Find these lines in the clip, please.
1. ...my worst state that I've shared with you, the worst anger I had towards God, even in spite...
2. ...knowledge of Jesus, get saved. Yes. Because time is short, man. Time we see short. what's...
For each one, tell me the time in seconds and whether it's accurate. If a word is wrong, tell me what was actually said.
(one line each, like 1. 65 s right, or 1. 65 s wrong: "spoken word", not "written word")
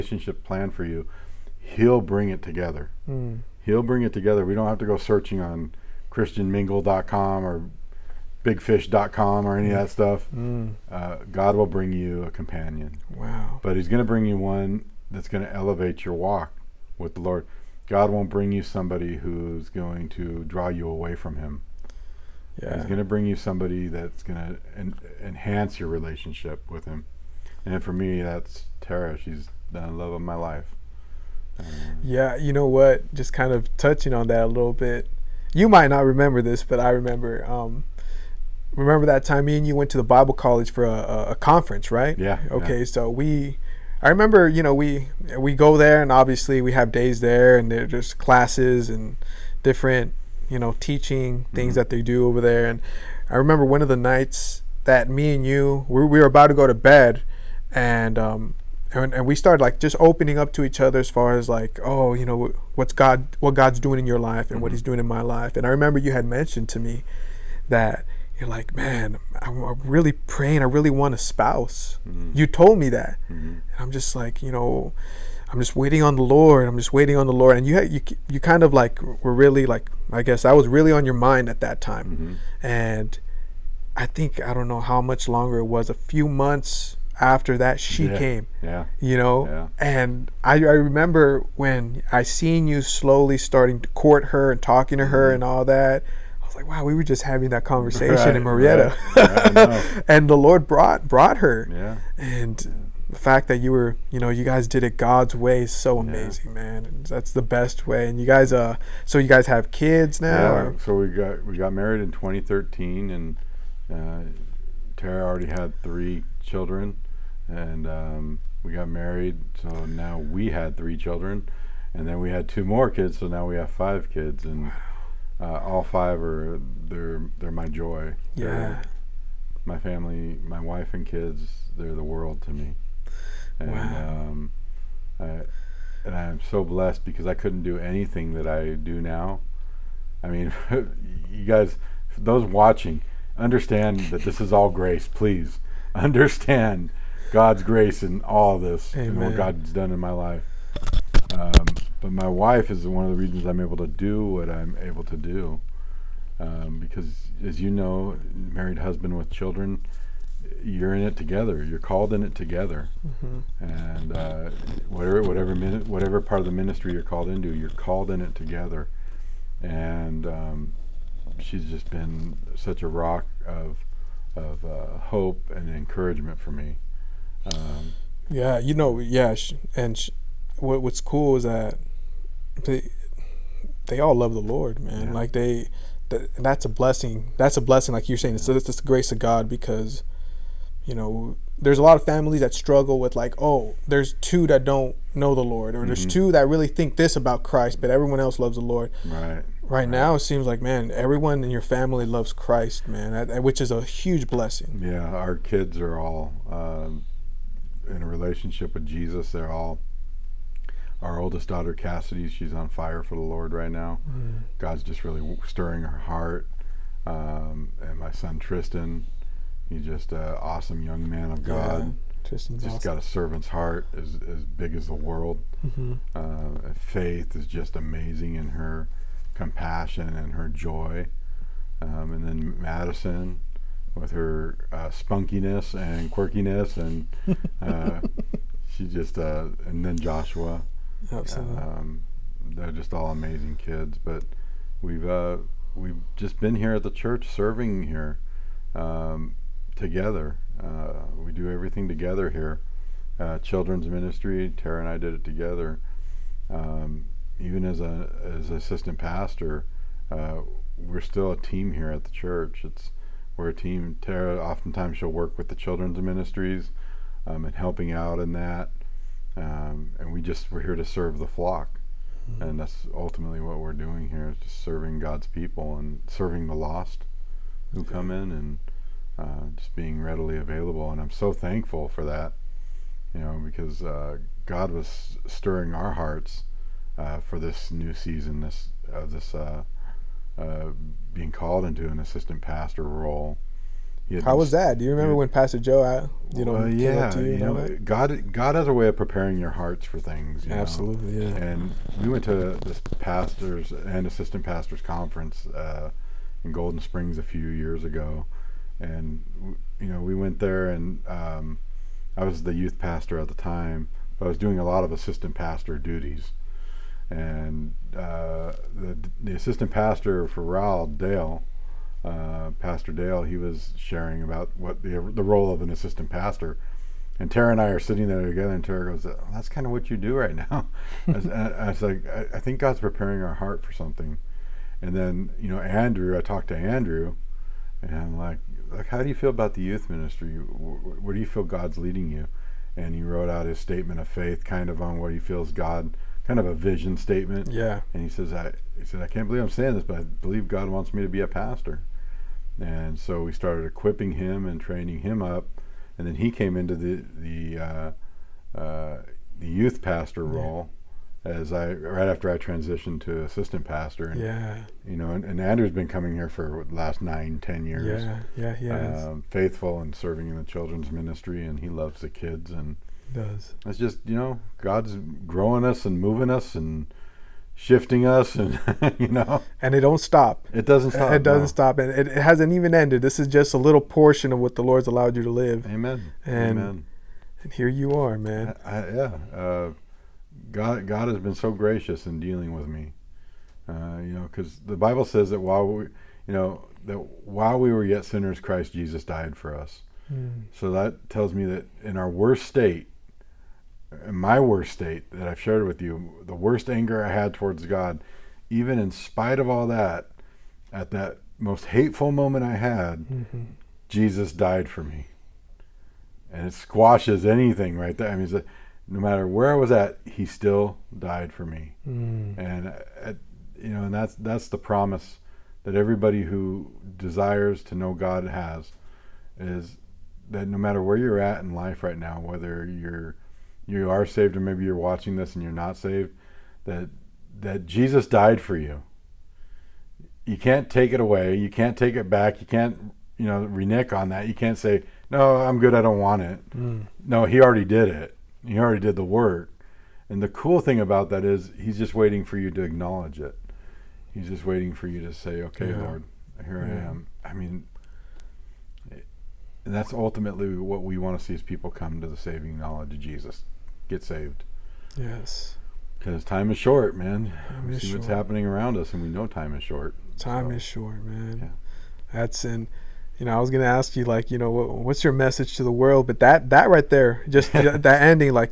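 1. 404 s right
2. 462 s right.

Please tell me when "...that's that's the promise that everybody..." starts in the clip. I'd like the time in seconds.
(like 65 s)
423 s.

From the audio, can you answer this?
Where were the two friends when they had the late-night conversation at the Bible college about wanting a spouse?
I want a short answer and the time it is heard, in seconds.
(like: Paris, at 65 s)
Marietta, at 98 s.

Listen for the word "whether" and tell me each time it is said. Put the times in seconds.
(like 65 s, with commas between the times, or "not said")
432 s.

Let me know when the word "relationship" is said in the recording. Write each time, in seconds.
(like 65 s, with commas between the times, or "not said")
25 s, 208 s.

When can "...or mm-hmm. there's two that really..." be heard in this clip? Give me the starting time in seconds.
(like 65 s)
195 s.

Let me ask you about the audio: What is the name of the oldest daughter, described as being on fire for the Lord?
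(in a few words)
Cassidy.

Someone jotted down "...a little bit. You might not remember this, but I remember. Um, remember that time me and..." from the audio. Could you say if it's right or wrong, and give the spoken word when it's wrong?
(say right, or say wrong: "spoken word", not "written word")
right.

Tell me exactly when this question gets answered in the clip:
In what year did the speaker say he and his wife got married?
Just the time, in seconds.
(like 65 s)
112 s.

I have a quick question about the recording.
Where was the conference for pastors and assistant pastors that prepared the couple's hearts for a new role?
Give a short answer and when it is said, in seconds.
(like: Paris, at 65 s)
Golden Springs, at 306 s.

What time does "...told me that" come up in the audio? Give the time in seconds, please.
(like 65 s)
72 s.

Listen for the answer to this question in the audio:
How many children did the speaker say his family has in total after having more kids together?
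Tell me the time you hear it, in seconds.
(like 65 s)
123 s.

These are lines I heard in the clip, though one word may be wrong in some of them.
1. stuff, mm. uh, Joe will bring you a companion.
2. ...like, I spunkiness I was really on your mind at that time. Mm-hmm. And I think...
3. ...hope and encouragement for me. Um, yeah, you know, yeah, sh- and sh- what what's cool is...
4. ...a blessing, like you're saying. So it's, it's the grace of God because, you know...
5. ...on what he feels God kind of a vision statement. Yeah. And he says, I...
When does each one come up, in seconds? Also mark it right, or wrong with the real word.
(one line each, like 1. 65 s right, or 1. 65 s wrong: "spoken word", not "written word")
1. 9 s wrong: "God", not "Joe"
2. 79 s wrong: "guess", not "spunkiness"
3. 174 s right
4. 187 s right
5. 344 s right.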